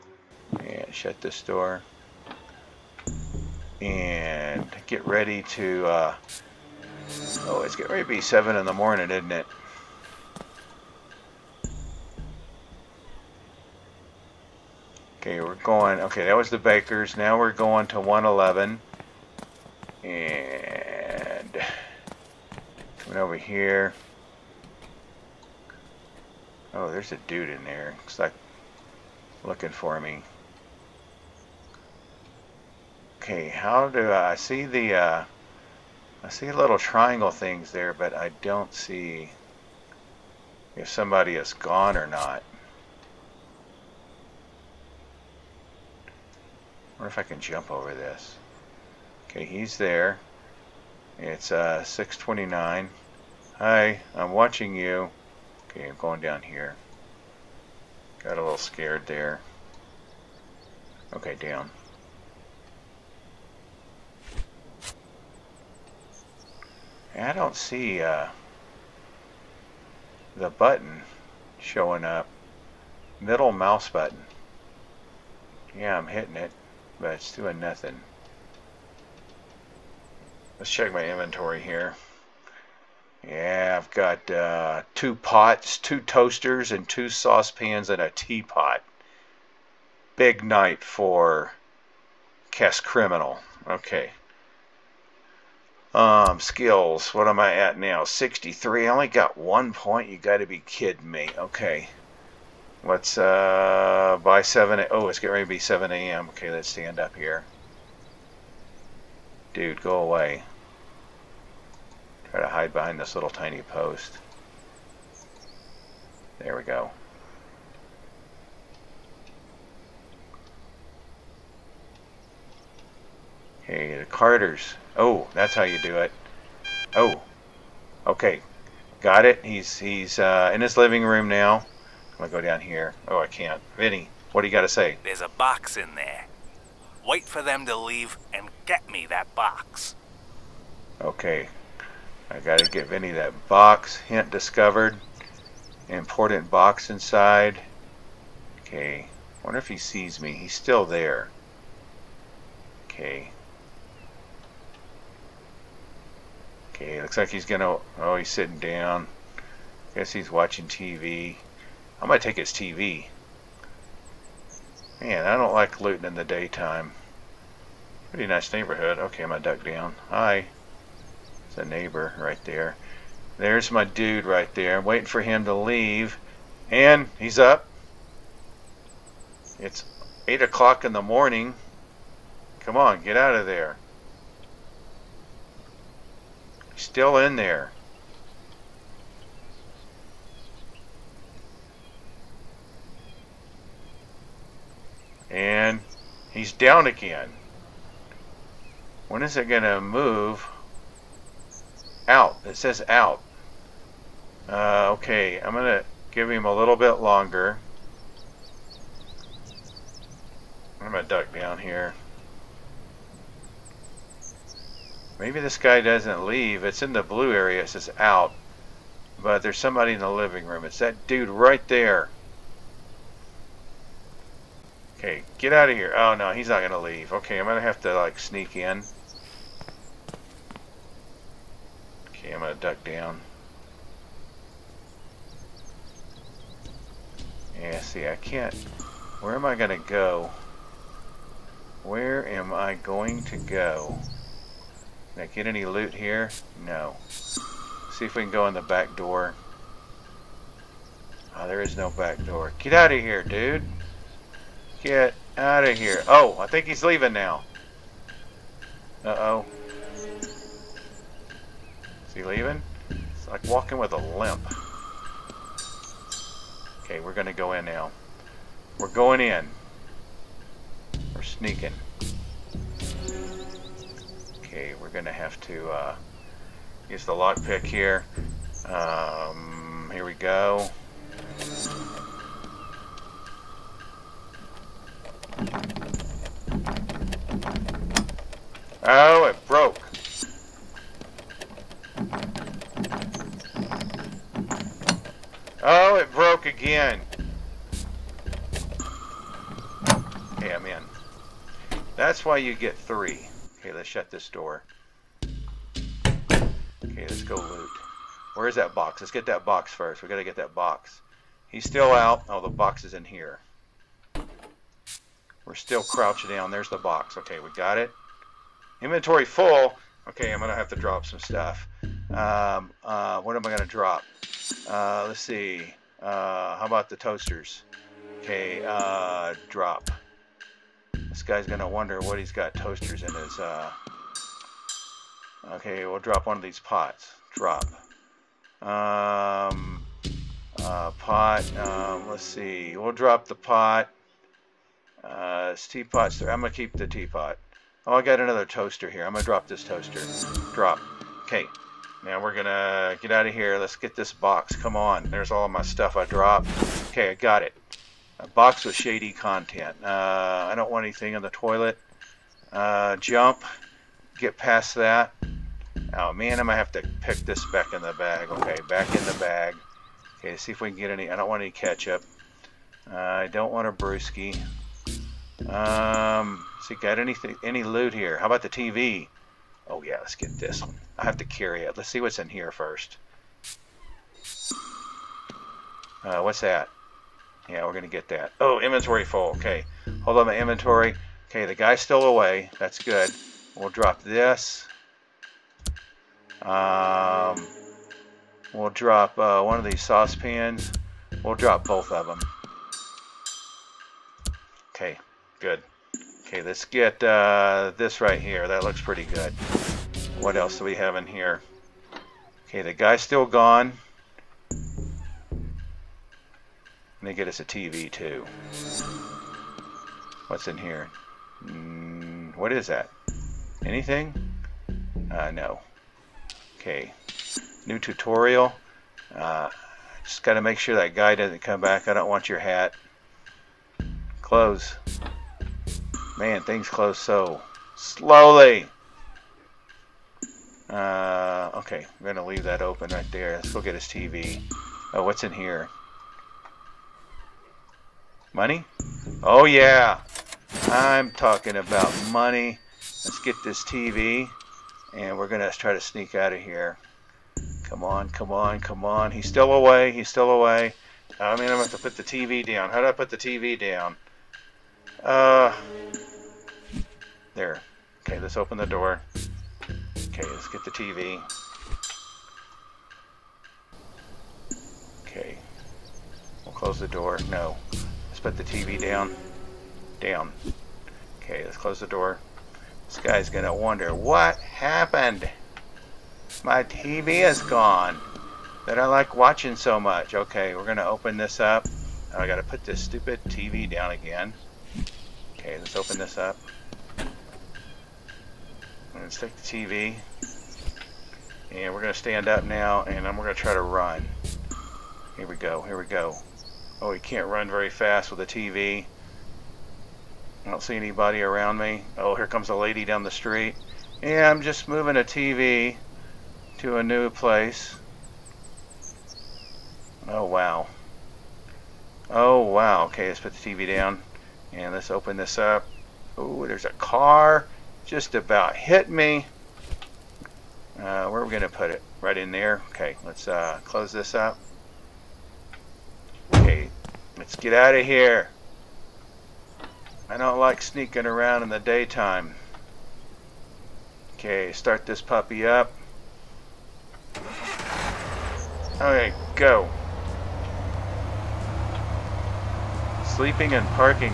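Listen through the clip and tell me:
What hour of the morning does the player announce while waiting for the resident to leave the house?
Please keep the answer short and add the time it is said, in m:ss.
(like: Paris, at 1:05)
8, at 3:00.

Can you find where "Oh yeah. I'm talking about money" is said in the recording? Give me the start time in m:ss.
7:29.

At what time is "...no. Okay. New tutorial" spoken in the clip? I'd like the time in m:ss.
7:05.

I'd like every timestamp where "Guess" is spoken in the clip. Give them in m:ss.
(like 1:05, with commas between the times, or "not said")
2:39.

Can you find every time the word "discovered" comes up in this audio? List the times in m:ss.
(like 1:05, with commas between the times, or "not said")
2:24.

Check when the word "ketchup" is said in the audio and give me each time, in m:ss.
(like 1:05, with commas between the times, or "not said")
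6:11.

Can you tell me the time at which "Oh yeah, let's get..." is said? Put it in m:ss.
6:19.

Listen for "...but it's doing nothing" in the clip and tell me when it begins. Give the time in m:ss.
1:16.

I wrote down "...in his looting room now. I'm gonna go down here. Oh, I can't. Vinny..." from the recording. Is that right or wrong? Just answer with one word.
wrong.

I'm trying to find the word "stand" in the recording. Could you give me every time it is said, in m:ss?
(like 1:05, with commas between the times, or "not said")
1:46, 8:21.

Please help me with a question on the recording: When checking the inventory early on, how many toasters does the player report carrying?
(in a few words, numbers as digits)
2.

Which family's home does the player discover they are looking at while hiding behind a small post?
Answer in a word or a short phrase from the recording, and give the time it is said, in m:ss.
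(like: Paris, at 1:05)
The Carters, at 2:03.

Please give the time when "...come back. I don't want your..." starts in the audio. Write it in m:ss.
7:11.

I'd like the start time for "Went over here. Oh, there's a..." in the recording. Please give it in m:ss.
0:23.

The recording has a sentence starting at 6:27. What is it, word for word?
Yeah, we're going to get that.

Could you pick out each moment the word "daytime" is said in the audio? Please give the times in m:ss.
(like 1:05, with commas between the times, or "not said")
2:46, 9:01.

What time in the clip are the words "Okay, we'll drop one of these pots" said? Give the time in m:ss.
5:35.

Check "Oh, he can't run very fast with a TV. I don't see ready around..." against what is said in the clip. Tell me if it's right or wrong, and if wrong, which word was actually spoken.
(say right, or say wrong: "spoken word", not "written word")
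wrong: "anybody", not "ready".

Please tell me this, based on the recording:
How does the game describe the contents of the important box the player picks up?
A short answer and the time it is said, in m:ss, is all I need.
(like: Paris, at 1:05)
shady content, at 5:58.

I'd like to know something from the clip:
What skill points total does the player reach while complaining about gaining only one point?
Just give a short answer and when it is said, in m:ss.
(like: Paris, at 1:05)
63, at 1:38.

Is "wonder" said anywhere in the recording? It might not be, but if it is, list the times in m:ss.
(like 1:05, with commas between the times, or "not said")
0:47, 2:29, 5:31, 8:03.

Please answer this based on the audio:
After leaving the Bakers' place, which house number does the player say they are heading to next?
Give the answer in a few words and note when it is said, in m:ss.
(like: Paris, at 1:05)
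111, at 0:18.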